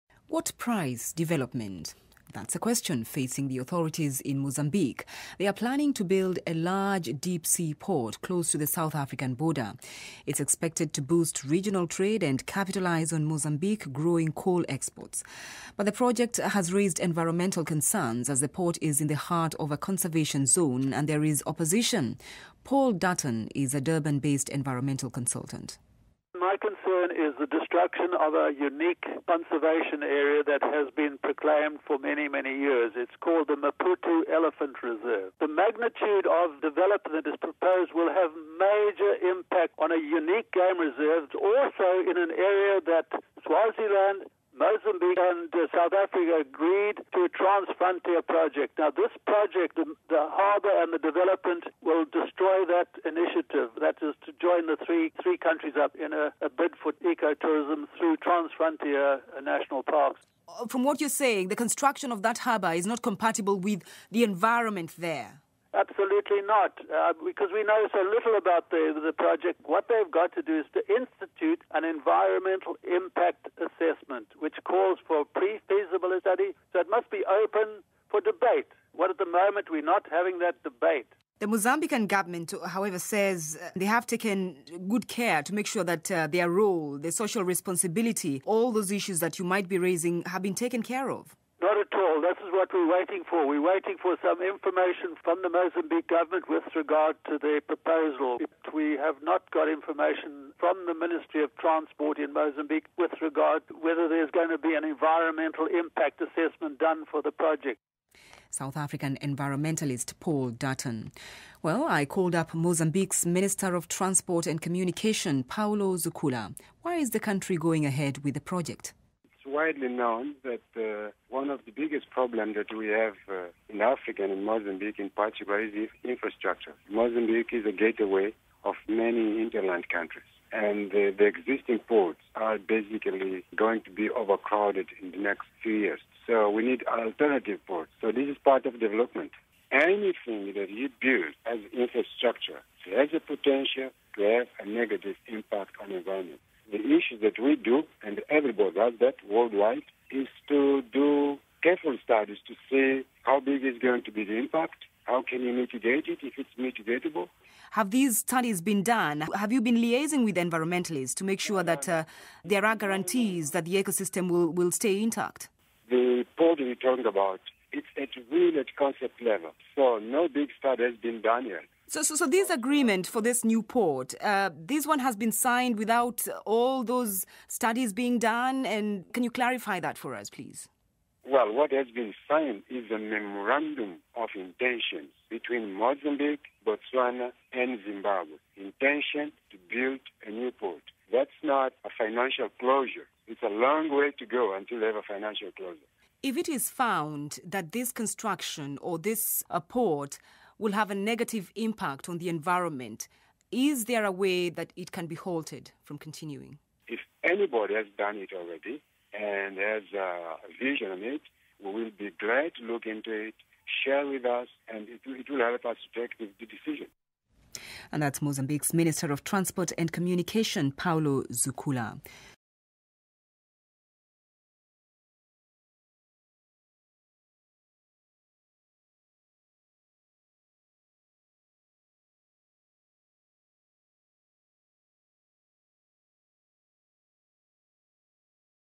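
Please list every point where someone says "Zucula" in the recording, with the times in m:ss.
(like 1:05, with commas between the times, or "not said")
1:55, 3:41.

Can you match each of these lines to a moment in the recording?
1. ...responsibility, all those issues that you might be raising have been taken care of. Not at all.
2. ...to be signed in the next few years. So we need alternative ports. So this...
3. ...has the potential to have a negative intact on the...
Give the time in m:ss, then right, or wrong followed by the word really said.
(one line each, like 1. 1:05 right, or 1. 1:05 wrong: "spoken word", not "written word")
1. 1:27 right
2. 2:13 wrong: "overcrowded", not "signed"
3. 2:22 wrong: "impact", not "intact".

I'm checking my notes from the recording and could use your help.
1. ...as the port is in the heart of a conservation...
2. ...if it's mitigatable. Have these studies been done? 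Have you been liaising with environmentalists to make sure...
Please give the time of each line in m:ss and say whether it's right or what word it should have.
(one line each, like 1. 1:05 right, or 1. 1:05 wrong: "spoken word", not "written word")
1. 0:18 right
2. 2:36 right.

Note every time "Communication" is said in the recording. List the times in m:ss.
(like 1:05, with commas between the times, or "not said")
1:54, 3:39.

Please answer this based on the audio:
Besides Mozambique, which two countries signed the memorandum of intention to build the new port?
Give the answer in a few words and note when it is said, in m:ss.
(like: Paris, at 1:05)
Botswana and Zimbabwe, at 3:06.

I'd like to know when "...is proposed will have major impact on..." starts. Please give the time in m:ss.
0:37.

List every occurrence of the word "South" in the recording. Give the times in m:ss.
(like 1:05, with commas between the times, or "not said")
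0:08, 0:45, 1:48.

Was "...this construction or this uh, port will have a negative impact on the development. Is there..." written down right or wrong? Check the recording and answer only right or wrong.
wrong.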